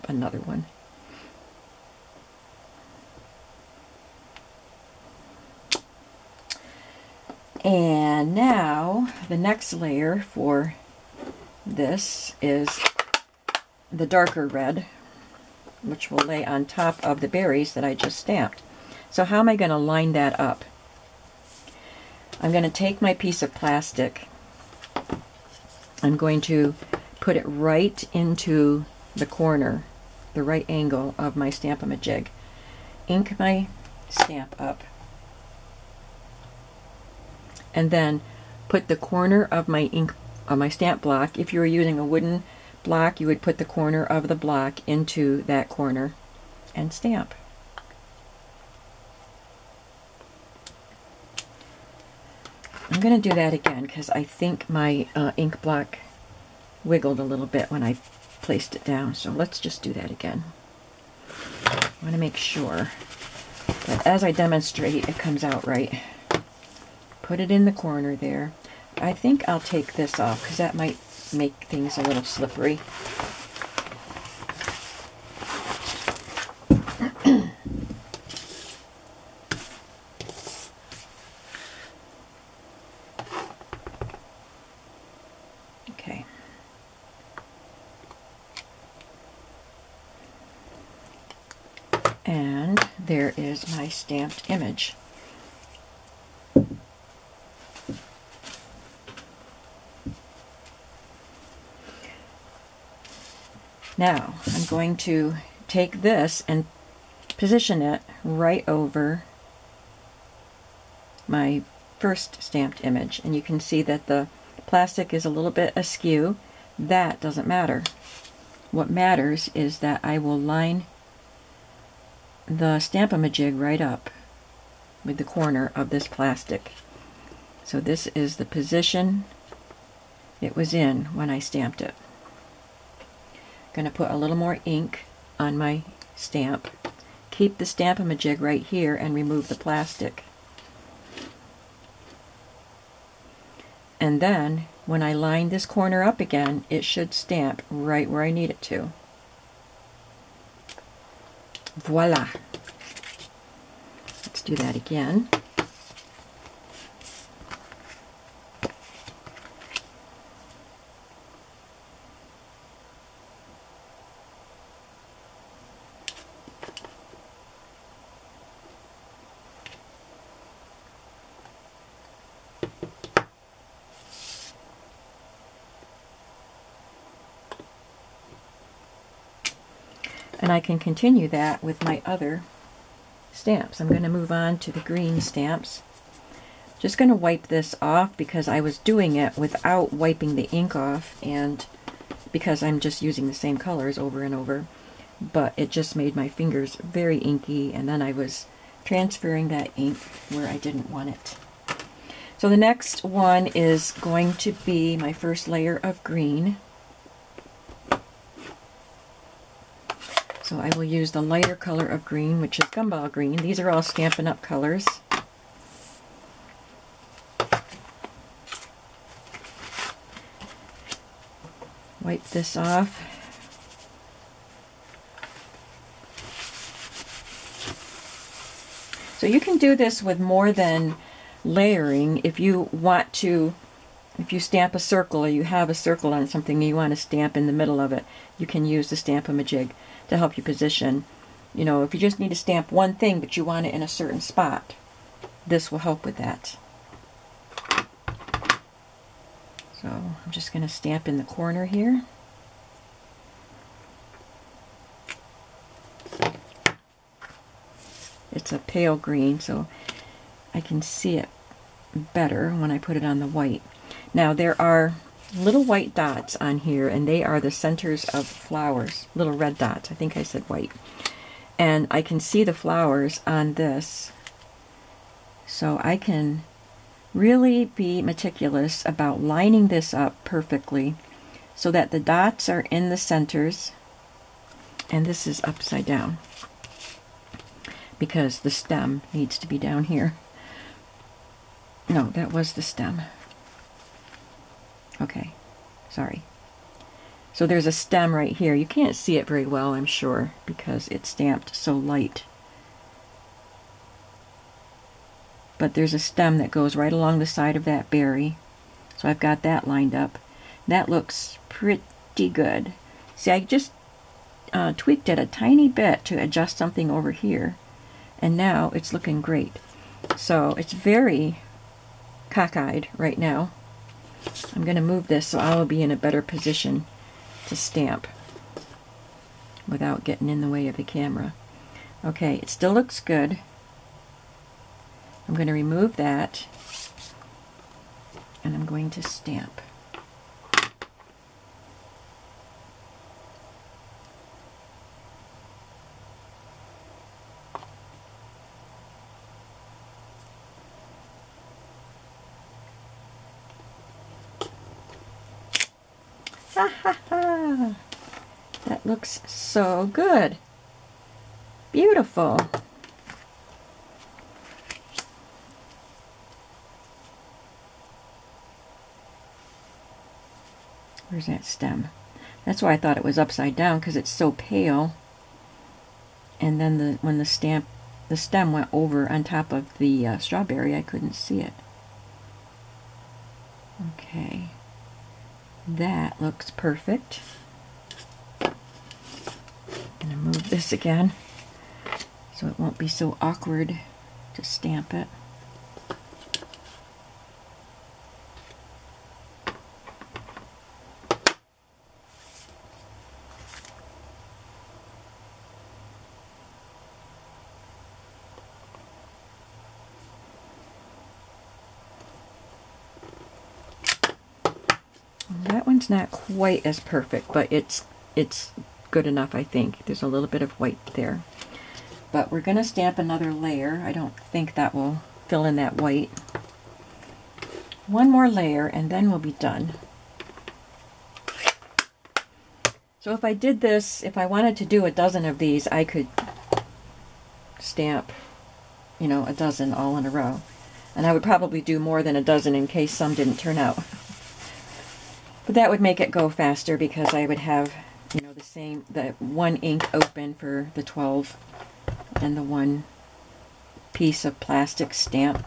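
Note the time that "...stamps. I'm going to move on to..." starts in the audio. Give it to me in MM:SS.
03:03.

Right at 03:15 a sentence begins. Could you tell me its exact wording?
But it just made my fingers very inky and then I was transferring that ink where I didn't want it.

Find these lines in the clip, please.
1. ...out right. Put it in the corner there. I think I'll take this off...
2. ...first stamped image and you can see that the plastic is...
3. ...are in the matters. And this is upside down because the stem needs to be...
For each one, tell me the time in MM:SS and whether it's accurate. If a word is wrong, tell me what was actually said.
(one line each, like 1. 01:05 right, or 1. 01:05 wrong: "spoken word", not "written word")
1. 01:05 right
2. 01:51 right
3. 04:42 wrong: "centers", not "matters".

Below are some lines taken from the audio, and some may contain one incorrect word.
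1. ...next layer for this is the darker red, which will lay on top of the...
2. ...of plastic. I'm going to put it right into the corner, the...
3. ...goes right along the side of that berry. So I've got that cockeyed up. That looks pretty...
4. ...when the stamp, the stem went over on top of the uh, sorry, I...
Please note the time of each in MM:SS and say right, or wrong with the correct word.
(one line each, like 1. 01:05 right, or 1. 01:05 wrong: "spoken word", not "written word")
1. 00:09 right
2. 00:23 right
3. 05:06 wrong: "lined", not "cockeyed"
4. 06:17 wrong: "strawberry", not "sorry".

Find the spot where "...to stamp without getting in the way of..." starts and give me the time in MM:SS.
05:27.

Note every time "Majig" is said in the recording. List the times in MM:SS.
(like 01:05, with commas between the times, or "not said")
00:31, 02:02, 02:17.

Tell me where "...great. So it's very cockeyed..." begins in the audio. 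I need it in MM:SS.
05:19.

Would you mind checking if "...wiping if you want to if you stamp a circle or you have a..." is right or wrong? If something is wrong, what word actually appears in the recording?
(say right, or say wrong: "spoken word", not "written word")
wrong: "layering", not "wiping".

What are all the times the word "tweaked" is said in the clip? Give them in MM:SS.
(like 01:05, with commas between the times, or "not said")
05:14.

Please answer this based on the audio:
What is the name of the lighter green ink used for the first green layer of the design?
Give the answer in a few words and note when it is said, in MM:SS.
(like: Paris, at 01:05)
Gumball Green, at 03:32.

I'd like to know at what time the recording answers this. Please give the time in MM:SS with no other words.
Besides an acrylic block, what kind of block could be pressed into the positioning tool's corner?
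00:42.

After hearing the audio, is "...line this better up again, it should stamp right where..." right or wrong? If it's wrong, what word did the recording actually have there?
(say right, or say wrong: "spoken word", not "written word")
wrong: "corner", not "better".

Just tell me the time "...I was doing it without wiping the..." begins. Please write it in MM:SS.
03:08.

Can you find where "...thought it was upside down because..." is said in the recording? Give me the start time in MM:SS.
06:12.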